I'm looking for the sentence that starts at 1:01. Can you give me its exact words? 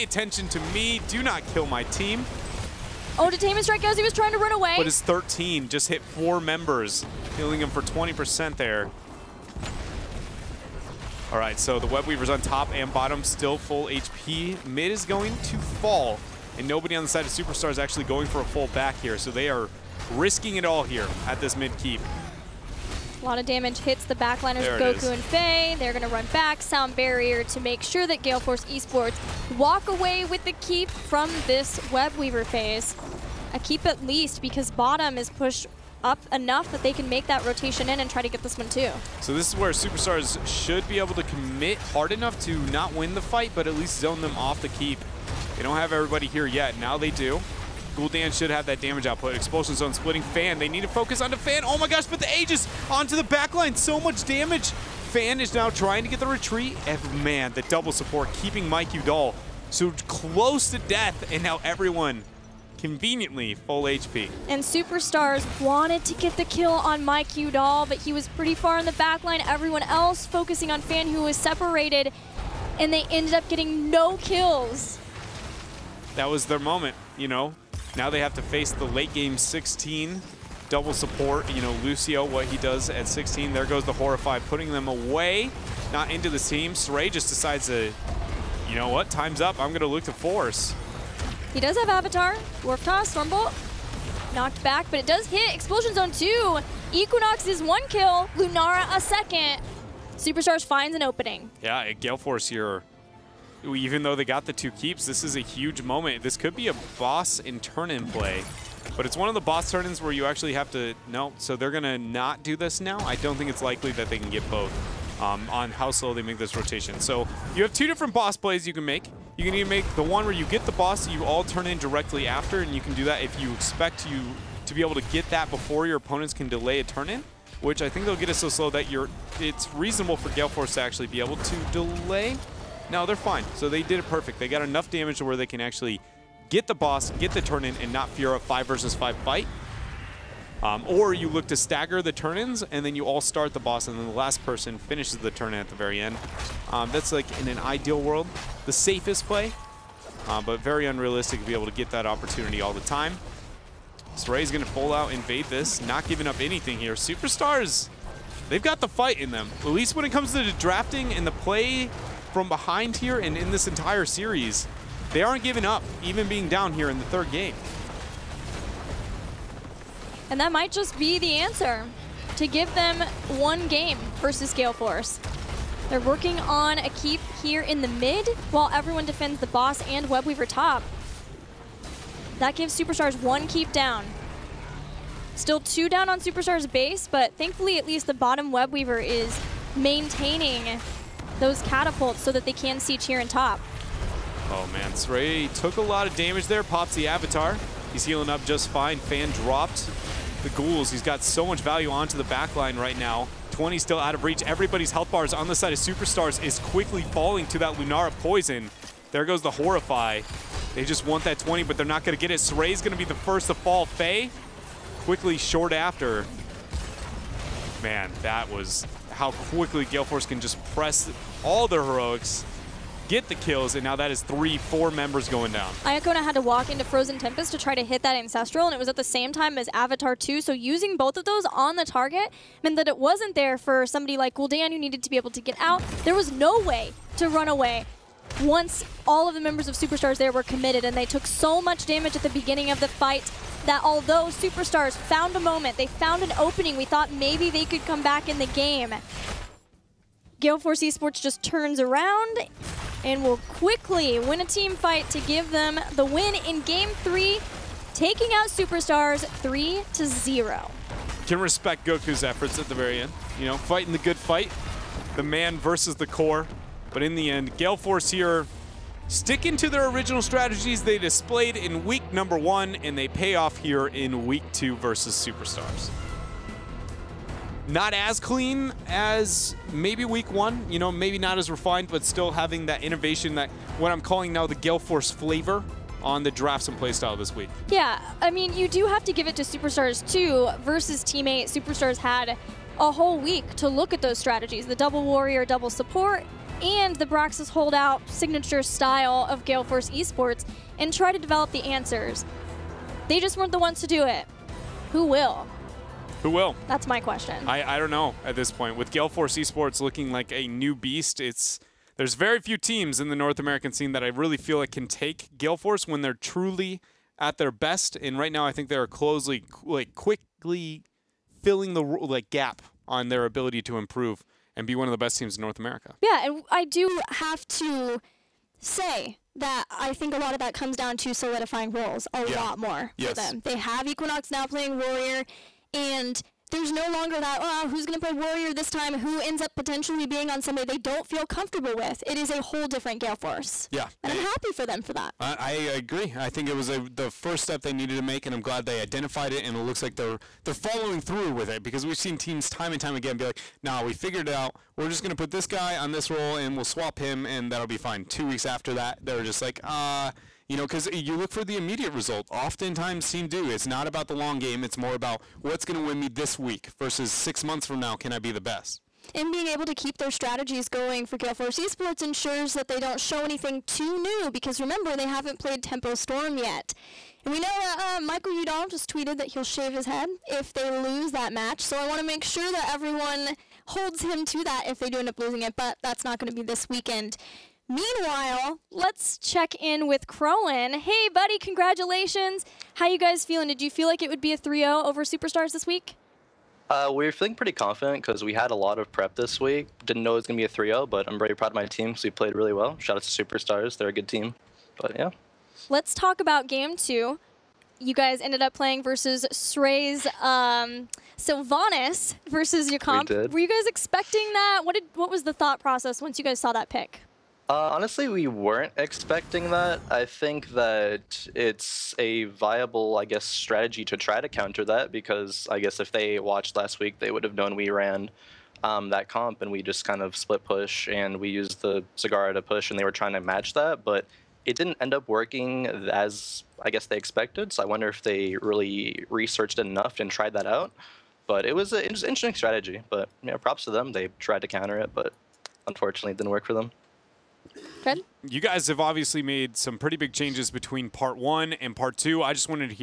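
And now everyone conveniently full HP.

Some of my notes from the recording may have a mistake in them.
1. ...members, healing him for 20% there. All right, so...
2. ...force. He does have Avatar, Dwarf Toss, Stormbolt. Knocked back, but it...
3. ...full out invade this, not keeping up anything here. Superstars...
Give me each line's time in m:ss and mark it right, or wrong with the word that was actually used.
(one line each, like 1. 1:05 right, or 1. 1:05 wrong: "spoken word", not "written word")
1. 0:06 right
2. 1:30 right
3. 2:34 wrong: "giving", not "keeping".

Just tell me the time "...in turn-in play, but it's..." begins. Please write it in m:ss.
1:47.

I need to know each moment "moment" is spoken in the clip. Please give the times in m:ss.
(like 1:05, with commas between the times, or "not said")
1:16, 1:45, 4:05.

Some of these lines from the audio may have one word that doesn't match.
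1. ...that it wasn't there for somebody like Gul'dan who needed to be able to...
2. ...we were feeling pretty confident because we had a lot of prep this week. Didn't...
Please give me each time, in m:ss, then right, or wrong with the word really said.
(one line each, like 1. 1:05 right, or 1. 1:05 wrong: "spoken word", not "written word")
1. 3:52 right
2. 6:36 right.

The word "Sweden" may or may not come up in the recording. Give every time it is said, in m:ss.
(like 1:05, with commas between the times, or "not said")
not said.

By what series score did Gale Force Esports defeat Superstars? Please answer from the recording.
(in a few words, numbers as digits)
3-0.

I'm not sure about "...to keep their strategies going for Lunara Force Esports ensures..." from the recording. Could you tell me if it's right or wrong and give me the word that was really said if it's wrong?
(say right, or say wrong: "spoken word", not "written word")
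wrong: "Gale", not "Lunara".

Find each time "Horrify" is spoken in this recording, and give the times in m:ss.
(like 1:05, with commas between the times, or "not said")
1:23, 3:29.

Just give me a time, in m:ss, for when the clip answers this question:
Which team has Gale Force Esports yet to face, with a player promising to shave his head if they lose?
6:15.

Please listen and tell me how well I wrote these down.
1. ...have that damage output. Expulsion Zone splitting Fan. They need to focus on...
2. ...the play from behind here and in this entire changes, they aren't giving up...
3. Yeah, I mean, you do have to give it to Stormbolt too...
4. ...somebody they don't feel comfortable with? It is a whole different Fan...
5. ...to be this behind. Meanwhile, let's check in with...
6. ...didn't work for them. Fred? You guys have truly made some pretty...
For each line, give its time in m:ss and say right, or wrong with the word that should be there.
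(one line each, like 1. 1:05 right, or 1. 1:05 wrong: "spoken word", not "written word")
1. 0:48 right
2. 2:41 wrong: "series", not "changes"
3. 4:47 wrong: "Superstars", not "Stormbolt"
4. 5:40 wrong: "Gale", not "Fan"
5. 6:26 wrong: "weekend", not "behind"
6. 7:26 wrong: "obviously", not "truly".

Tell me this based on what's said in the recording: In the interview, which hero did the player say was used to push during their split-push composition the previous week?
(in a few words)
Zagara.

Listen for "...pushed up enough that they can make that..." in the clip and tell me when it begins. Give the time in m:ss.
0:35.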